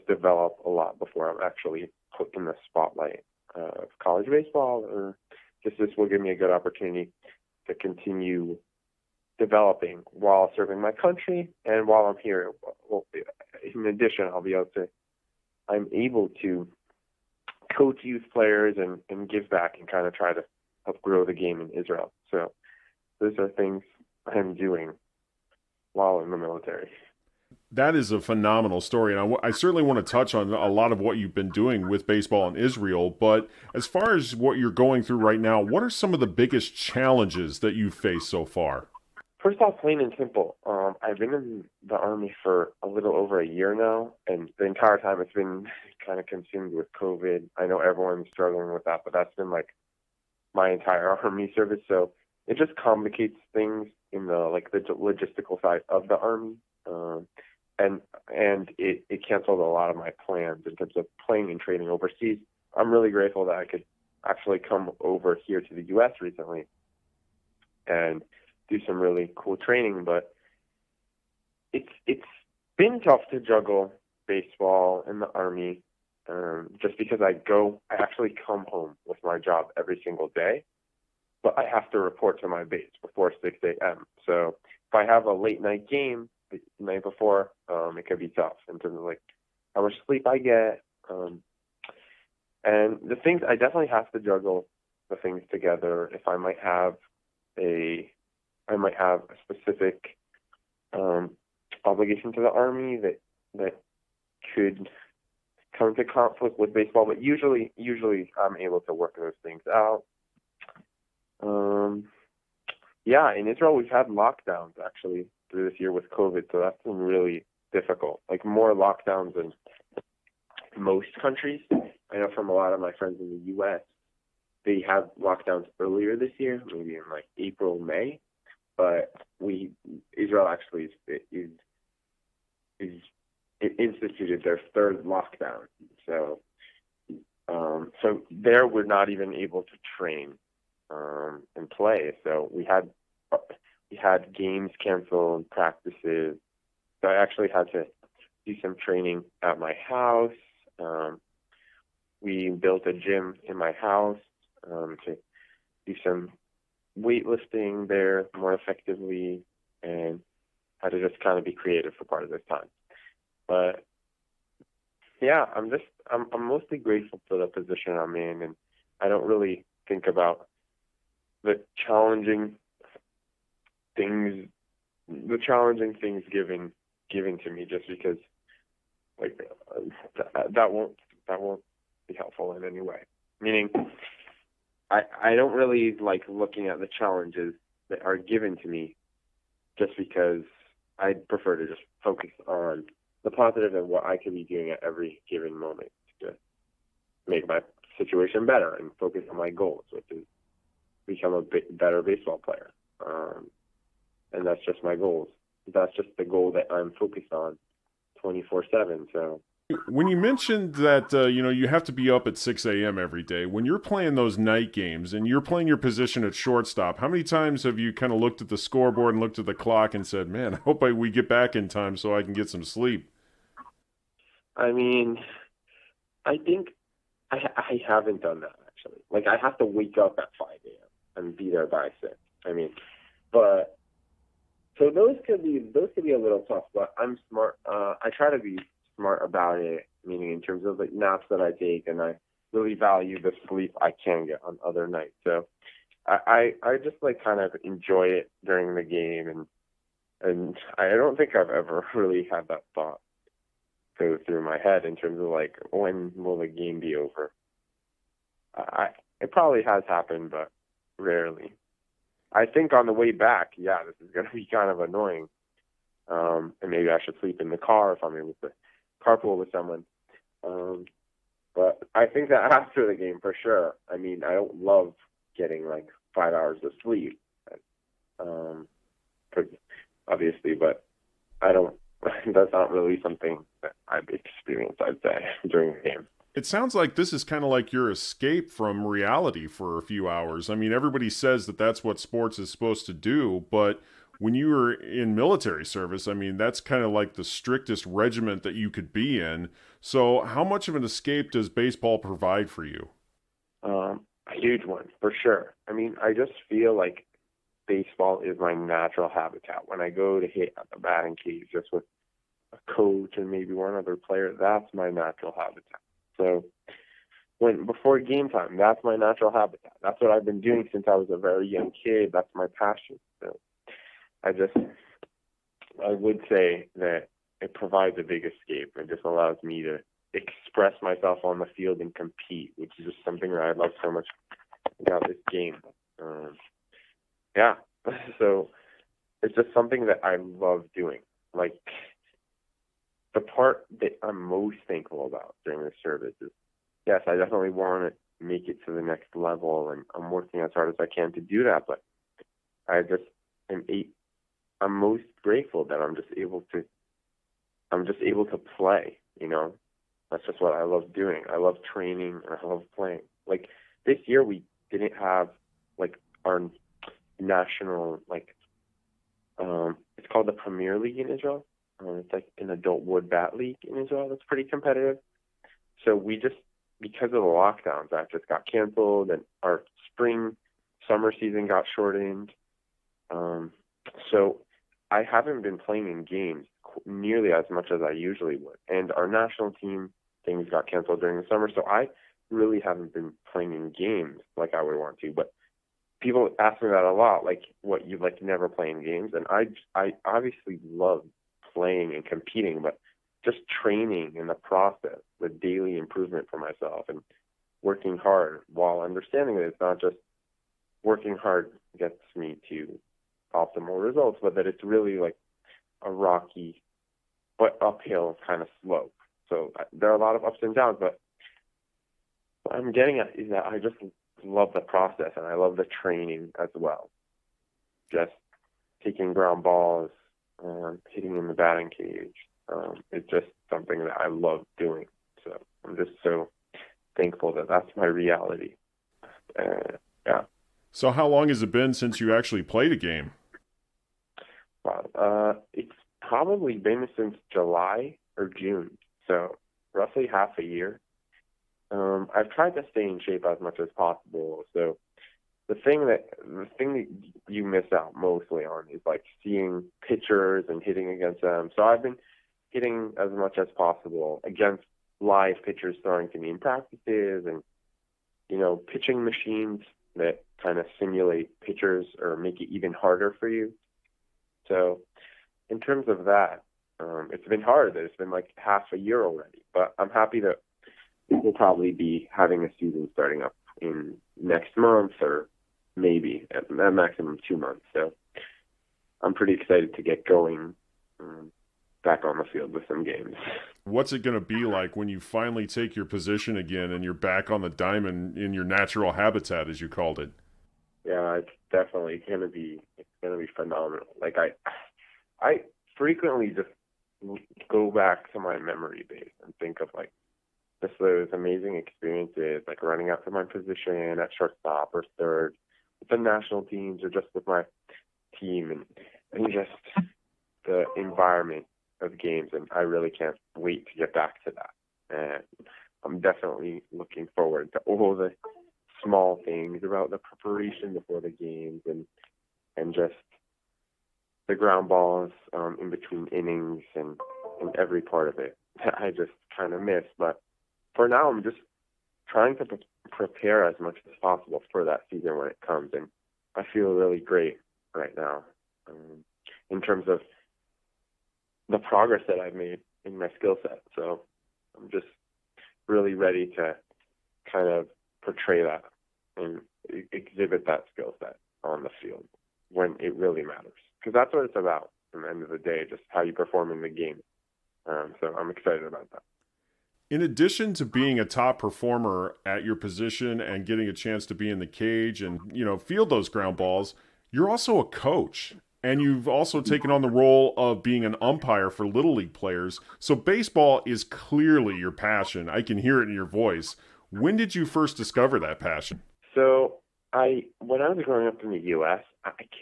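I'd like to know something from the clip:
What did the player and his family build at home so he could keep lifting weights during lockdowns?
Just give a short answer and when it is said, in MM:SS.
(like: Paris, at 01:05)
a gym, at 02:32.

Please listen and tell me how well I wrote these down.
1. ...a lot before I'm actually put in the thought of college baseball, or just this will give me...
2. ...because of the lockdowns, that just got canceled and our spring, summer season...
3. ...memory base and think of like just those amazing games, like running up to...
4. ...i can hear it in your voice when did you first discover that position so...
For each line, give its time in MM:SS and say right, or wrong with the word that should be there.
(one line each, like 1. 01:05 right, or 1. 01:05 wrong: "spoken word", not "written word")
1. 00:00 wrong: "spotlight", not "thought"
2. 06:16 right
3. 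08:28 wrong: "experiences", not "games"
4. 09:45 wrong: "passion", not "position".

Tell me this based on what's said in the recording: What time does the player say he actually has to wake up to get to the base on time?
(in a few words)
5 a.m.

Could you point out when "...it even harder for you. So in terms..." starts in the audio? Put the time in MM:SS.
07:52.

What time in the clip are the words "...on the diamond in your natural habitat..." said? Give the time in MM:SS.
08:17.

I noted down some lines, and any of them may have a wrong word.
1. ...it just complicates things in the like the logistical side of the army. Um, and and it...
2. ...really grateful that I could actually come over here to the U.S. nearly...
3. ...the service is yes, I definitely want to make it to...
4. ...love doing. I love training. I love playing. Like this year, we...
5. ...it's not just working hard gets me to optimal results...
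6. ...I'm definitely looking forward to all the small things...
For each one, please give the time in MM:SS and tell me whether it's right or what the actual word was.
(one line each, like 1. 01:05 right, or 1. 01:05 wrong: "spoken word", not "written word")
1. 00:52 right
2. 01:02 wrong: "recently", not "nearly"
3. 05:45 right
4. 06:00 right
5. 06:49 right
6. 08:45 right.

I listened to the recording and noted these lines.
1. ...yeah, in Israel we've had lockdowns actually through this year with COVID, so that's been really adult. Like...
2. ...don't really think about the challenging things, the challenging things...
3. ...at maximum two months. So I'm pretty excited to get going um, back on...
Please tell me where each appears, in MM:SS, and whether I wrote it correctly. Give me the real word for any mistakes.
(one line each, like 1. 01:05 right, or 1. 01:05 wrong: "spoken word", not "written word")
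1. 01:53 wrong: "difficult", not "adult"
2. 02:49 right
3. 08:06 right.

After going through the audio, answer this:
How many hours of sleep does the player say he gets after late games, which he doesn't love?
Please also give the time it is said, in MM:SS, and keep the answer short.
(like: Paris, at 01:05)
5, at 04:36.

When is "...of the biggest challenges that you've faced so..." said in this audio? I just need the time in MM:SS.
00:36.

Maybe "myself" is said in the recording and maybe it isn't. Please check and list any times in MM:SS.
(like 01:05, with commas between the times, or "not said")
05:30, 06:46.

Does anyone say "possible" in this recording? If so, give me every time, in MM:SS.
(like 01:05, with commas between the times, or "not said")
07:33, 07:43, 09:04.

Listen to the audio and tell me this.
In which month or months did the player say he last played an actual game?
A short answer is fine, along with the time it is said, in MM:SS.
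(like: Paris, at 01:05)
July or June, at 07:27.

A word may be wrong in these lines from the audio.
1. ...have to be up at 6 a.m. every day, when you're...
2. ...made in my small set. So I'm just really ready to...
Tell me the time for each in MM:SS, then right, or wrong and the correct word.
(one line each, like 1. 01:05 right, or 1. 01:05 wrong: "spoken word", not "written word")
1. 03:31 right
2. 09:12 wrong: "skill", not "small".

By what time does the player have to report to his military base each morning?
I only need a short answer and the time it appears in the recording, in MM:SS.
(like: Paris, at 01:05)
6 a.m., at 01:23.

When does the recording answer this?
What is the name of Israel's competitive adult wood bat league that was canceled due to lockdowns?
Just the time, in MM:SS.
06:10.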